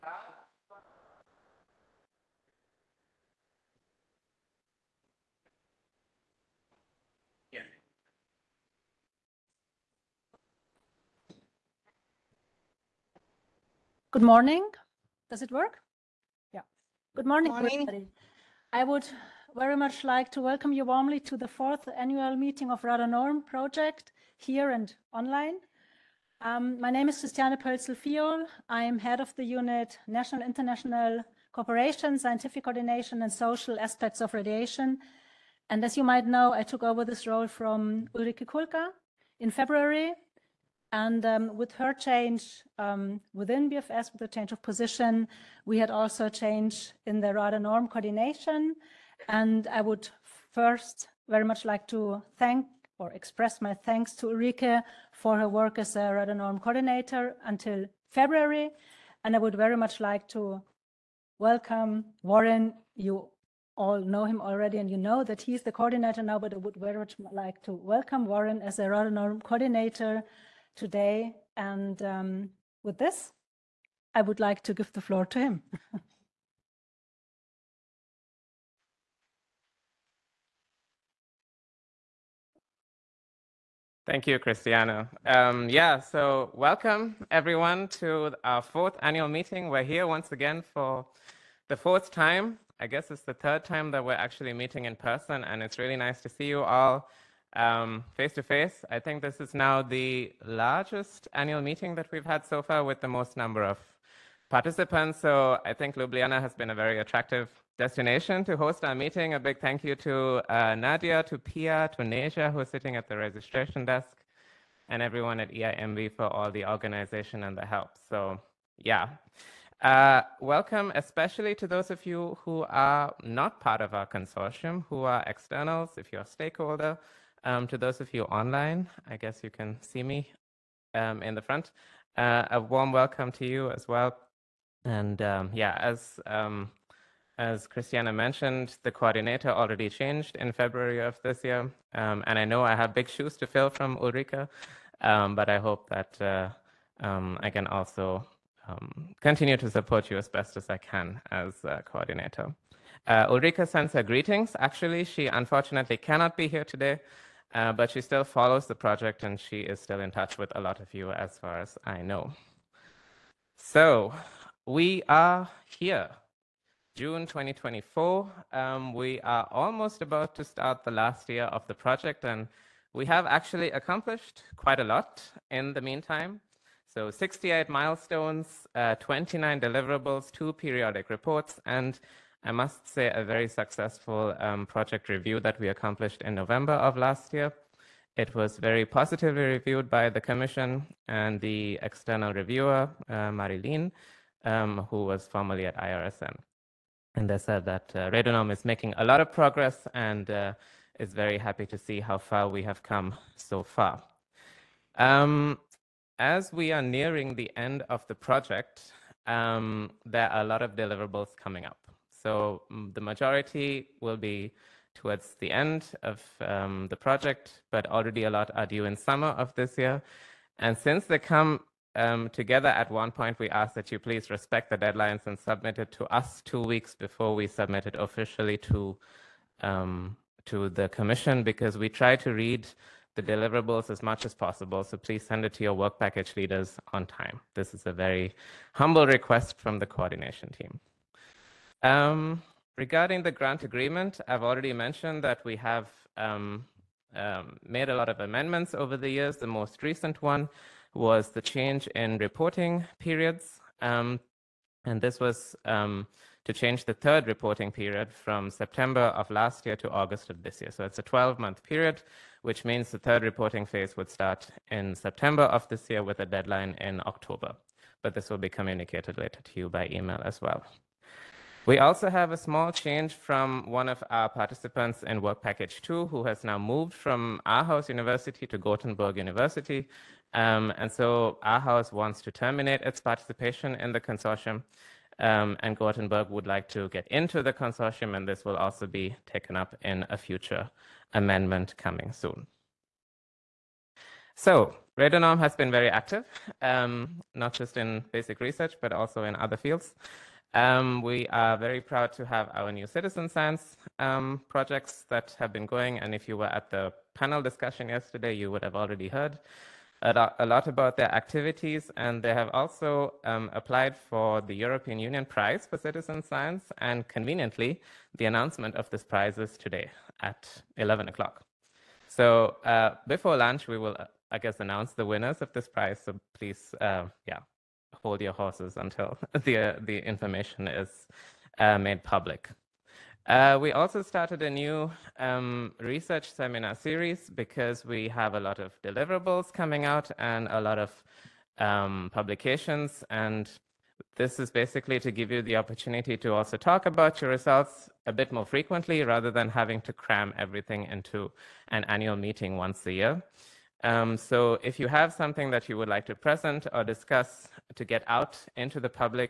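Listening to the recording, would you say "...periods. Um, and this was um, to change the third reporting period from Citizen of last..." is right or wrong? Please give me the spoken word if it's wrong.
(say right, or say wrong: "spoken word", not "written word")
wrong: "September", not "Citizen".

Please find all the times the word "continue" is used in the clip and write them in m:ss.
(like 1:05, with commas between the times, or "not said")
2:29.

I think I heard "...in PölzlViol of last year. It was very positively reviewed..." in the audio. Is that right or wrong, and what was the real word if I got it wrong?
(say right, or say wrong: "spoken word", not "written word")
wrong: "November", not "PölzlViol".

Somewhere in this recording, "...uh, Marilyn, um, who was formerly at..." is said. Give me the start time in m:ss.
3:13.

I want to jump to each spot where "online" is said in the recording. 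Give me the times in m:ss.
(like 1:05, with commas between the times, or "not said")
0:25, 2:08.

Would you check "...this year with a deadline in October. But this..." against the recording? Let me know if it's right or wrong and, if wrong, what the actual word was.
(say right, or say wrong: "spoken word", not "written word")
right.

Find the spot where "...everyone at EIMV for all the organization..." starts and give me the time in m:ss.
1:55.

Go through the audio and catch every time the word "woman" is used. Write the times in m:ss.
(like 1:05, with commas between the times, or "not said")
not said.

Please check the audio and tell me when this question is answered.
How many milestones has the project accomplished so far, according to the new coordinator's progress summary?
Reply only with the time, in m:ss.
2:57.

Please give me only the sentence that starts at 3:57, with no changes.
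This is a very humble request from the coordination team.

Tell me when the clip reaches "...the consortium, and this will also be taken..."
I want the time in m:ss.
4:47.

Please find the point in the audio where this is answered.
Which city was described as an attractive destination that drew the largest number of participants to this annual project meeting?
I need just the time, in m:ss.
1:45.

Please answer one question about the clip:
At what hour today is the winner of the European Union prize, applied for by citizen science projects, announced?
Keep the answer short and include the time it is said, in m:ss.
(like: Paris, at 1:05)
11 o'clock, at 5:20.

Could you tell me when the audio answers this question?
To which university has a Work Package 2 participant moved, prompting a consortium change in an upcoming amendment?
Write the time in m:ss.
4:38.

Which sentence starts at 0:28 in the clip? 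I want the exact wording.
I am head of the unit National International Cooperation, Scientific Coordination and Social Aspects of Radiation.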